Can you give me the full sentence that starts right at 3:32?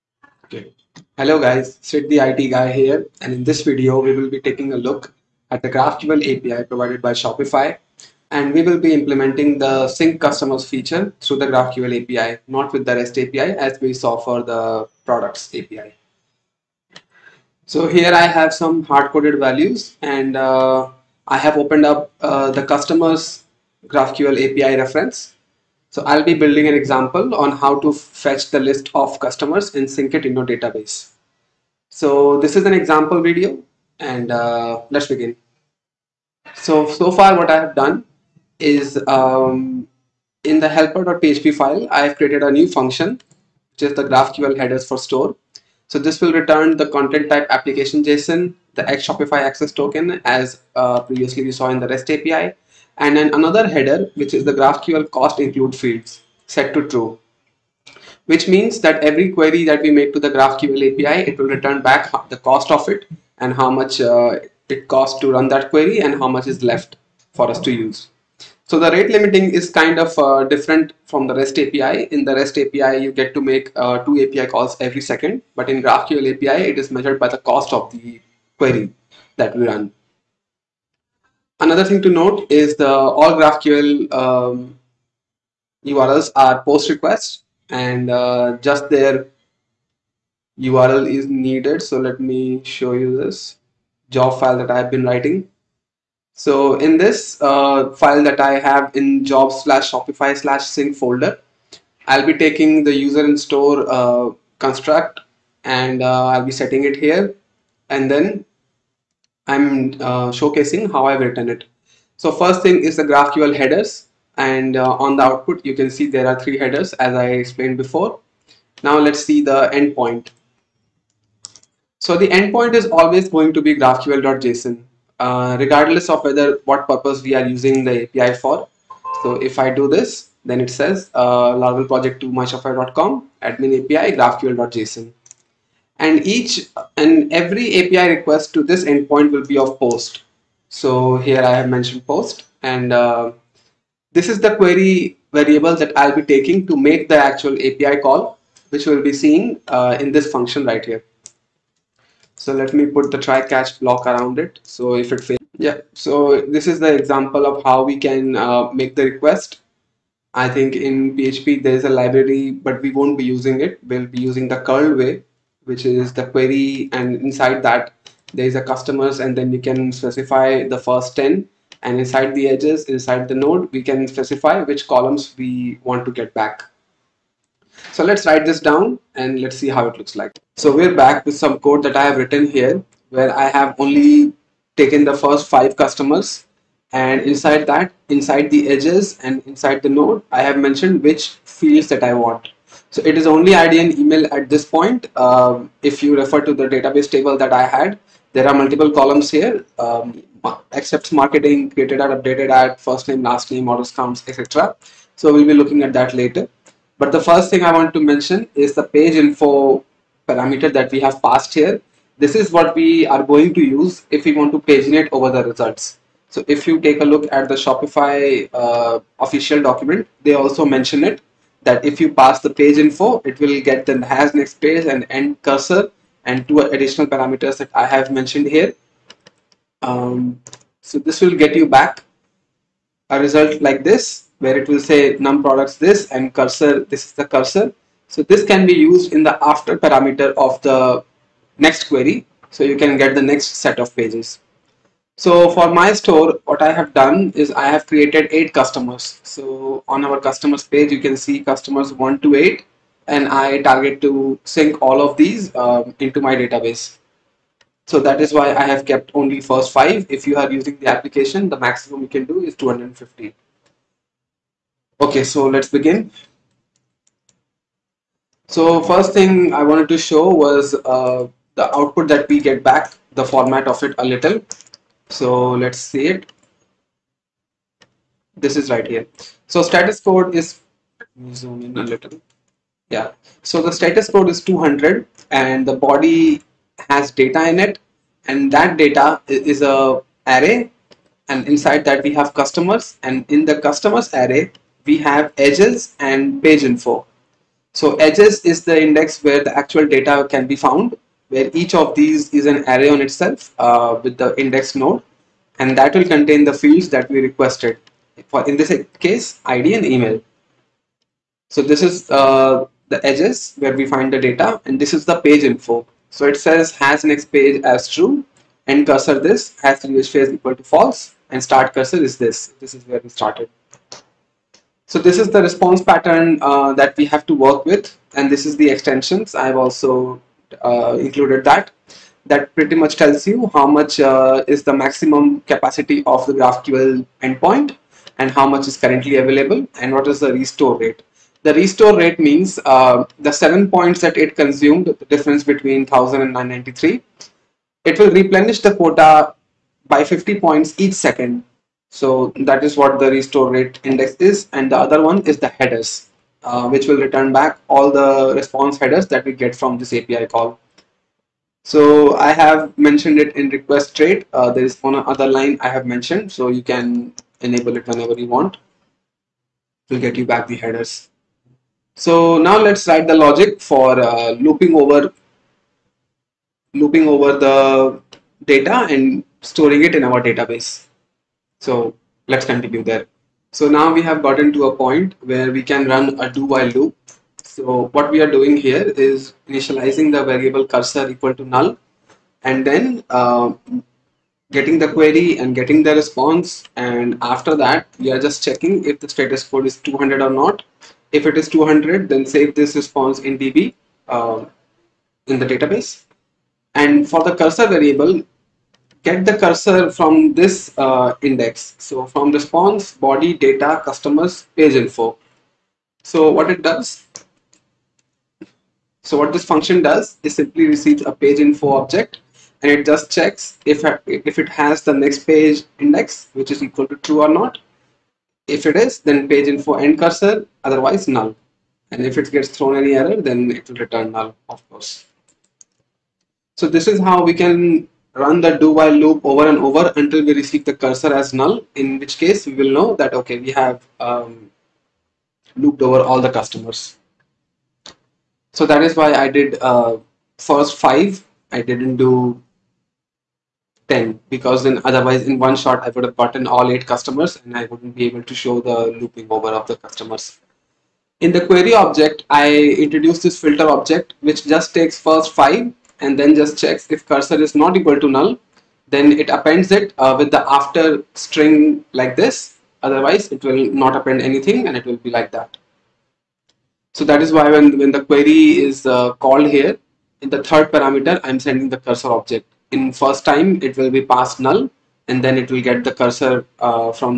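This is what we are going to use if we want to paginate over the results.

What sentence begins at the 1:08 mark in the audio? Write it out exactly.
So the rate limiting is kind of uh, different from the REST API.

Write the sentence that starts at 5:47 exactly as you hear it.
It will replenish the quota by 50 points each second.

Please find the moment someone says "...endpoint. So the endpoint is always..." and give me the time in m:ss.
1:59.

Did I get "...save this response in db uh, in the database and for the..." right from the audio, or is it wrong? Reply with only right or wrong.
right.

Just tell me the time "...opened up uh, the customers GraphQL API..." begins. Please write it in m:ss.
0:21.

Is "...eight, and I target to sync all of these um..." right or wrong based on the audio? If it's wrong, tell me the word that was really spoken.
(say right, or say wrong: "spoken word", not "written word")
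right.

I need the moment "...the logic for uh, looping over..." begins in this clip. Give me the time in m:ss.
6:13.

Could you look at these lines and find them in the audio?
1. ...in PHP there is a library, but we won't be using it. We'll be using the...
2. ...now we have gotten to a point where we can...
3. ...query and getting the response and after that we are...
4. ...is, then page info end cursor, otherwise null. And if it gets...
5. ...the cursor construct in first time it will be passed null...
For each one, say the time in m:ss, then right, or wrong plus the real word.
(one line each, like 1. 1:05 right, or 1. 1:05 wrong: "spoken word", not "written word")
1. 2:40 right
2. 6:23 right
3. 6:34 right
4. 7:08 right
5. 8:01 wrong: "object", not "construct".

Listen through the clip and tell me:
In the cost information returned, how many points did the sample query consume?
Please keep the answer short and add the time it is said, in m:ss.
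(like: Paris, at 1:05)
7, at 5:43.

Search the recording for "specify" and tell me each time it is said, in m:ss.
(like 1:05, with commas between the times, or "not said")
2:49, 2:54.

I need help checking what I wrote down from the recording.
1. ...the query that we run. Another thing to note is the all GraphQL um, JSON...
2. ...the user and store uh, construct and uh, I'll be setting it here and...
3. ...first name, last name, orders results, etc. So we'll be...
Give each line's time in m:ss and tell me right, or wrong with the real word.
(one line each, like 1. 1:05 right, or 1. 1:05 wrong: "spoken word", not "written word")
1. 1:17 wrong: "URLs", not "JSON"
2. 1:42 right
3. 3:22 wrong: "counts", not "results".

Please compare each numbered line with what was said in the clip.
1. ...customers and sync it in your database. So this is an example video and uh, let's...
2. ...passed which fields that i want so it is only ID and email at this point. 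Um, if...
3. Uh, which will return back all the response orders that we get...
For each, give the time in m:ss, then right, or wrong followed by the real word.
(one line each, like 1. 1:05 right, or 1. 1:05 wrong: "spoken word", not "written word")
1. 0:29 right
2. 3:10 wrong: "mentioned", not "passed"
3. 5:56 wrong: "headers", not "orders".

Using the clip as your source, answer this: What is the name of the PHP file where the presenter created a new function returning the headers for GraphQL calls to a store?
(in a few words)
helper.php.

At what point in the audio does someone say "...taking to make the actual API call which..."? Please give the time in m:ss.
2:26.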